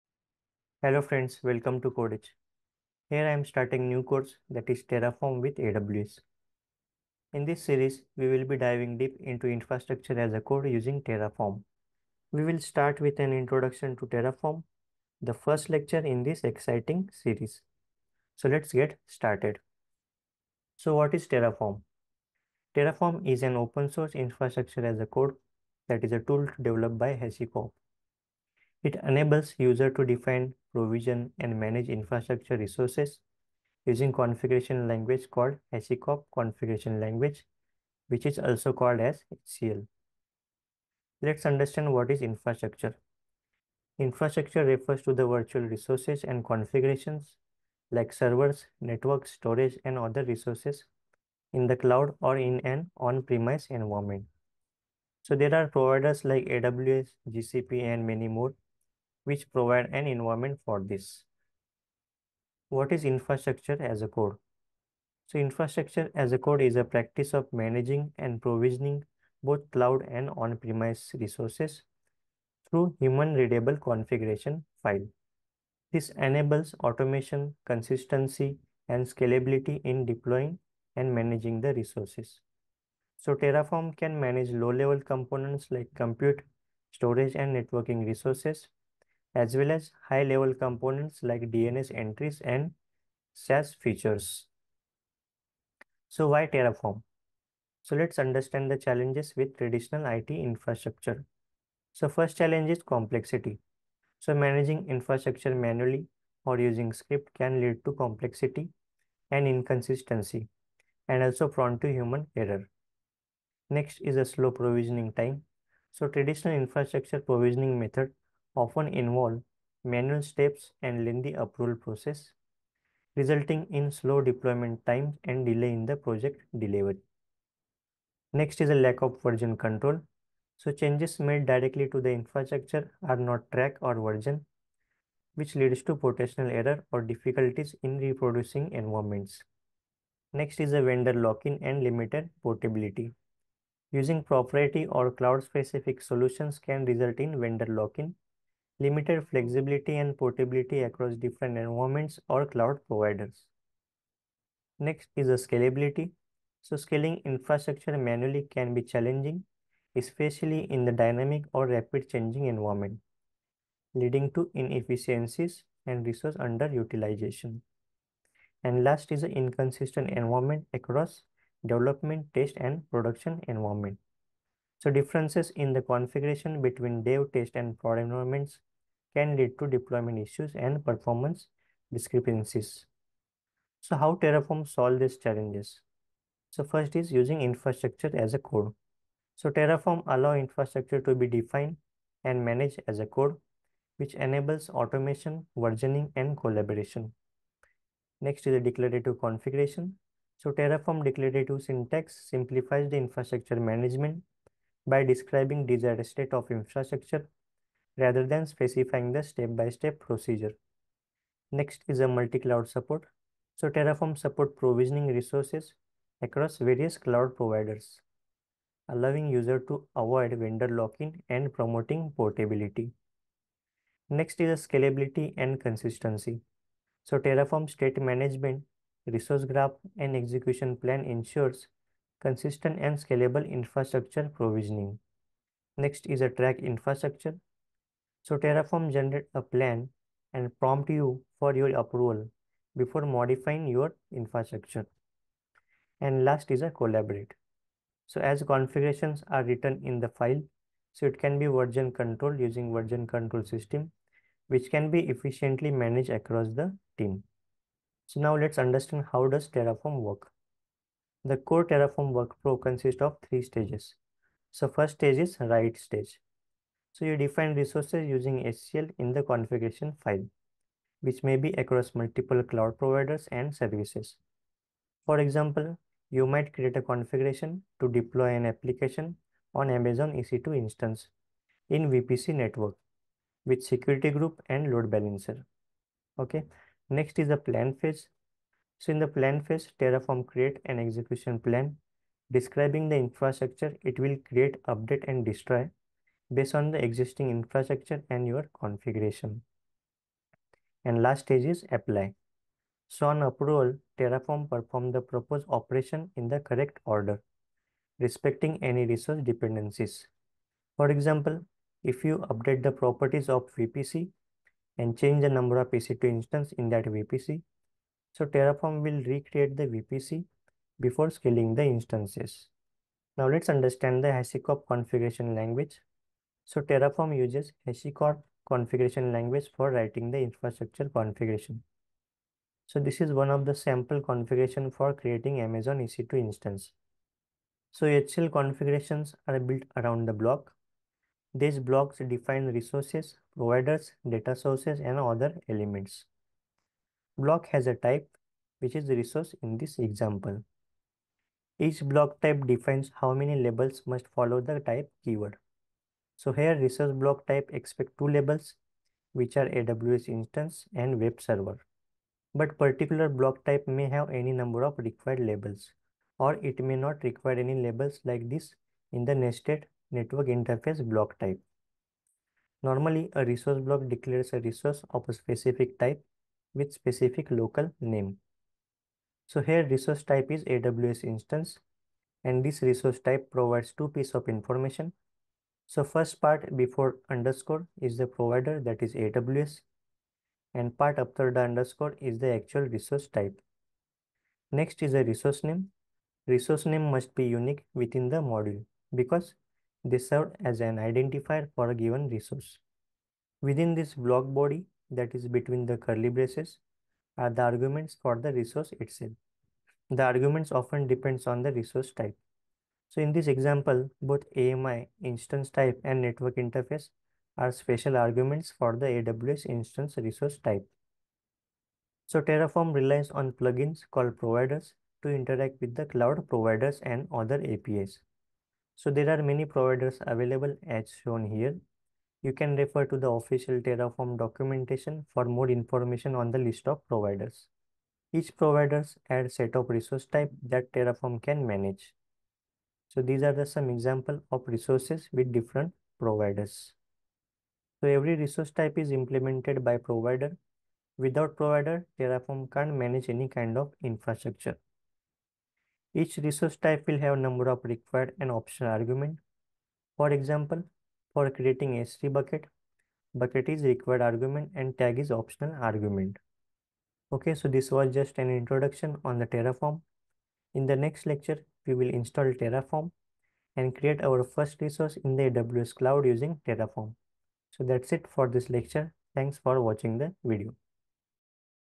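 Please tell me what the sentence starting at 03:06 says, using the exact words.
So first is using infrastructure as a code.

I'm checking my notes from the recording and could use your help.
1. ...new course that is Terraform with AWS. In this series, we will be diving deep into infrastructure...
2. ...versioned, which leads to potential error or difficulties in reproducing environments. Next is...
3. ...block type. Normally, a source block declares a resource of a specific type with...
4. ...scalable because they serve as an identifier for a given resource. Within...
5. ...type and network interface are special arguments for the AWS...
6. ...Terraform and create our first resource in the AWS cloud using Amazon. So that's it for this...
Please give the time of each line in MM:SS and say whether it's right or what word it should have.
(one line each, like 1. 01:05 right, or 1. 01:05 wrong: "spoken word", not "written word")
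1. 00:03 right
2. 02:13 right
3. 06:10 wrong: "resource", not "source"
4. 06:38 wrong: "module", not "scalable"
5. 06:55 right
6. 07:52 wrong: "Terraform", not "Amazon".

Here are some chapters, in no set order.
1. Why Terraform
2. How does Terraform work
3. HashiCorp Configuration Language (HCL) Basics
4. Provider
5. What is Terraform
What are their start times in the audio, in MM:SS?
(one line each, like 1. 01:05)
1. 01:36
2. 04:18
3. 05:23
4. 07:01
5. 00:20.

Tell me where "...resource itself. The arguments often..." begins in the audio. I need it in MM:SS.
06:48.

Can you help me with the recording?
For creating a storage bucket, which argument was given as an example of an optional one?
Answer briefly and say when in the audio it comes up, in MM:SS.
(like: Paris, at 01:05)
tag, at 07:44.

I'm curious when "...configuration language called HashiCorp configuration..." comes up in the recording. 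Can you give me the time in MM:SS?
00:34.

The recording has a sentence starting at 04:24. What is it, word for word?
So first stage is write stage.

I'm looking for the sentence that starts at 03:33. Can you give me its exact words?
So Terraform support provisioning resources across various cloud providers, allowing user to avoid vendor lock-in and promoting portability.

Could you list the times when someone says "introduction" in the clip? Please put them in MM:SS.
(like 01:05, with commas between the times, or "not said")
00:13, 07:48.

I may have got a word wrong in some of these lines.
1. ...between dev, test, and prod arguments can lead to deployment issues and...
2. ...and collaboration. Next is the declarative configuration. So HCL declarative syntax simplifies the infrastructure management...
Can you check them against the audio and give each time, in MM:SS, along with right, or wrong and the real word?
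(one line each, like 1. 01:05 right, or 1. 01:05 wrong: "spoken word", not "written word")
1. 02:56 wrong: "environments", not "arguments"
2. 03:16 wrong: "Terraform", not "HCL".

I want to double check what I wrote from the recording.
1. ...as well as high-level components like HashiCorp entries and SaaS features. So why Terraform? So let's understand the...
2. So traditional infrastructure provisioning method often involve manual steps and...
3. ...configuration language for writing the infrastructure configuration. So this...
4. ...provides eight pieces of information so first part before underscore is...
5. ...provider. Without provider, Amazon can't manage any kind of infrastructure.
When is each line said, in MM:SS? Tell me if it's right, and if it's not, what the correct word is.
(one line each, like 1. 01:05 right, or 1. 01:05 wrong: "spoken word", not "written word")
1. 01:29 wrong: "DNS", not "HashiCorp"
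2. 01:55 right
3. 05:28 right
4. 06:23 wrong: "two", not "eight"
5. 07:29 wrong: "Terraform", not "Amazon".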